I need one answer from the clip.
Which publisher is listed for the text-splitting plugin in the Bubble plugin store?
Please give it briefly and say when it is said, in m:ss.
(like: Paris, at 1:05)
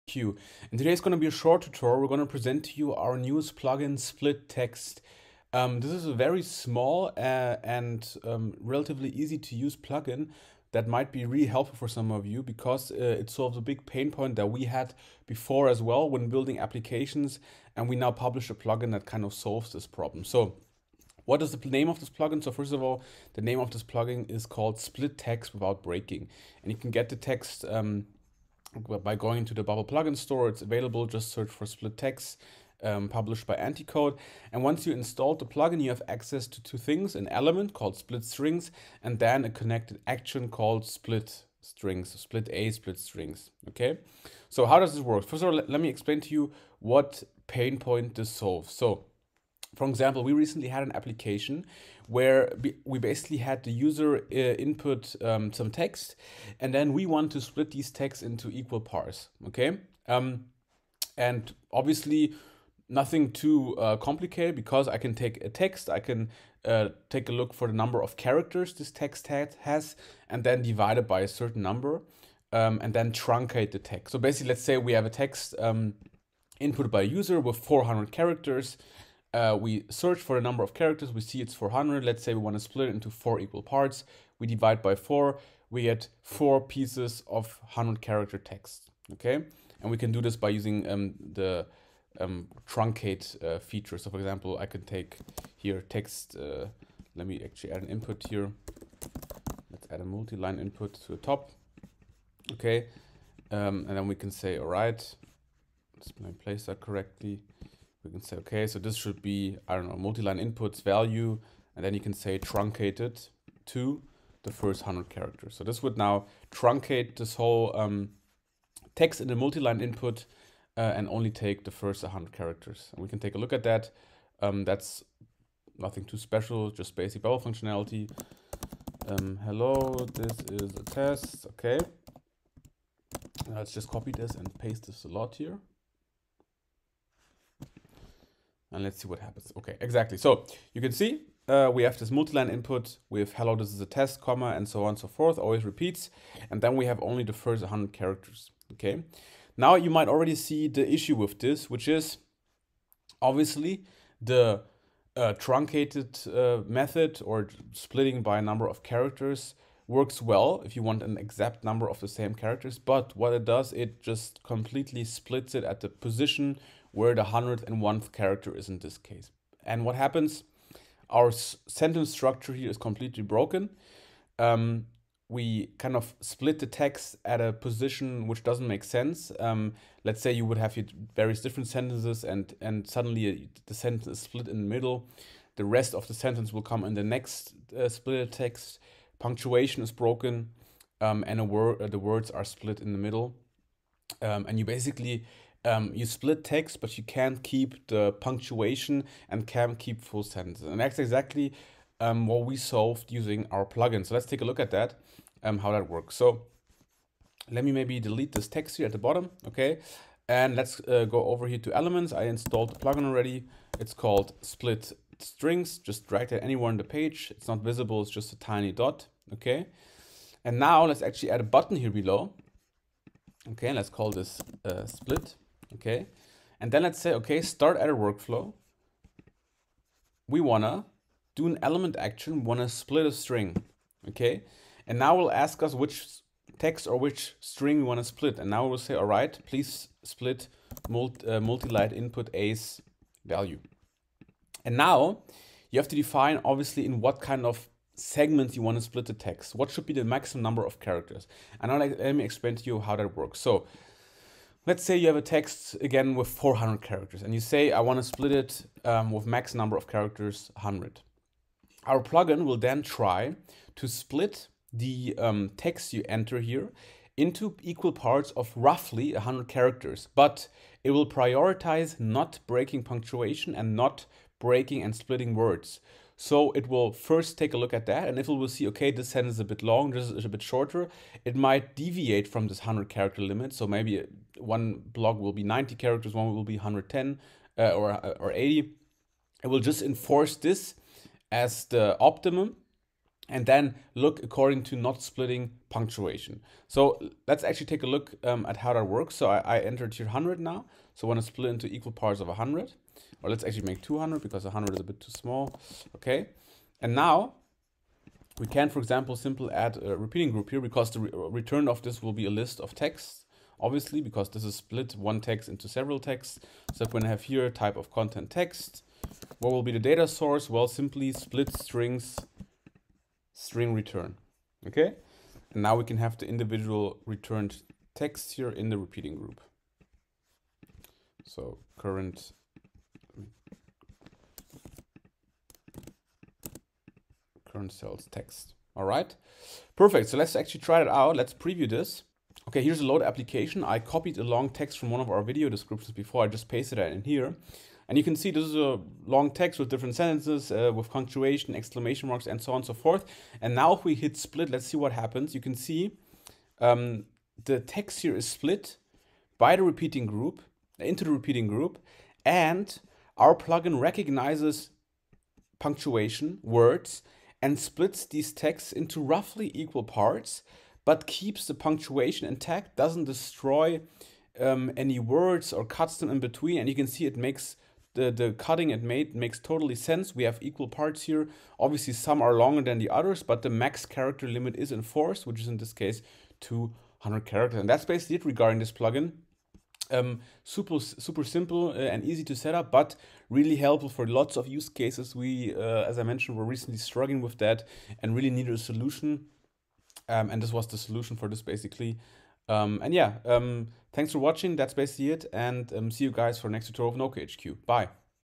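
Anticode, at 0:33.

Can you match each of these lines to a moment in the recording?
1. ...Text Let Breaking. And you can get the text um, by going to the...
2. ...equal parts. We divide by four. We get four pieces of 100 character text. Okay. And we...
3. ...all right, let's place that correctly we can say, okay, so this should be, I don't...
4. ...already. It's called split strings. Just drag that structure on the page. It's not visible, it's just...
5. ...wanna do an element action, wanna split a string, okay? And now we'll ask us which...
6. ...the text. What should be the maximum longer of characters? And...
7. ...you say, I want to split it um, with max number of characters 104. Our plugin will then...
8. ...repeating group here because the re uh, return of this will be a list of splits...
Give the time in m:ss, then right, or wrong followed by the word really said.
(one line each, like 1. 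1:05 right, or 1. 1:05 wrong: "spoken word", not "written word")
1. 0:25 wrong: "Without", not "Let"
2. 1:23 right
3. 1:44 right
4. 3:33 wrong: "anywhere", not "structure"
5. 3:50 right
6. 4:09 wrong: "number", not "longer"
7. 4:17 wrong: "100", not "104"
8. 5:09 wrong: "texts", not "splits".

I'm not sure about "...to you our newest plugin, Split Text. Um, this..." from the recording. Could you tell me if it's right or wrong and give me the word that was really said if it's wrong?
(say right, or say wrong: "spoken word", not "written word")
right.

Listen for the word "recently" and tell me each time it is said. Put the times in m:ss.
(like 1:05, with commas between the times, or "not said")
0:50, 6:36.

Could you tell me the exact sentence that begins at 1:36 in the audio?
Uh, let me actually add an input here.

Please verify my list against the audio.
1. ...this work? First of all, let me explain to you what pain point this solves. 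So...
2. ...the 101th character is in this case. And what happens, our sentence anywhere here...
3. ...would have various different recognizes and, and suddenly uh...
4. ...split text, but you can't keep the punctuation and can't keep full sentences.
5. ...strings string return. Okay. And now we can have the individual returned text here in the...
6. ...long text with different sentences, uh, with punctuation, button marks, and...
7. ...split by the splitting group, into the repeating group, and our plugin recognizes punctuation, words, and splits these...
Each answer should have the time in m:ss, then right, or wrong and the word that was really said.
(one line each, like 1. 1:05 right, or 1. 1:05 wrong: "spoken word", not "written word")
1. 0:44 right
2. 2:47 wrong: "structure", not "anywhere"
3. 3:00 wrong: "sentences", not "recognizes"
4. 3:16 right
5. 5:21 right
6. 5:49 wrong: "exclamation", not "button"
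7. 5:58 wrong: "repeating", not "splitting".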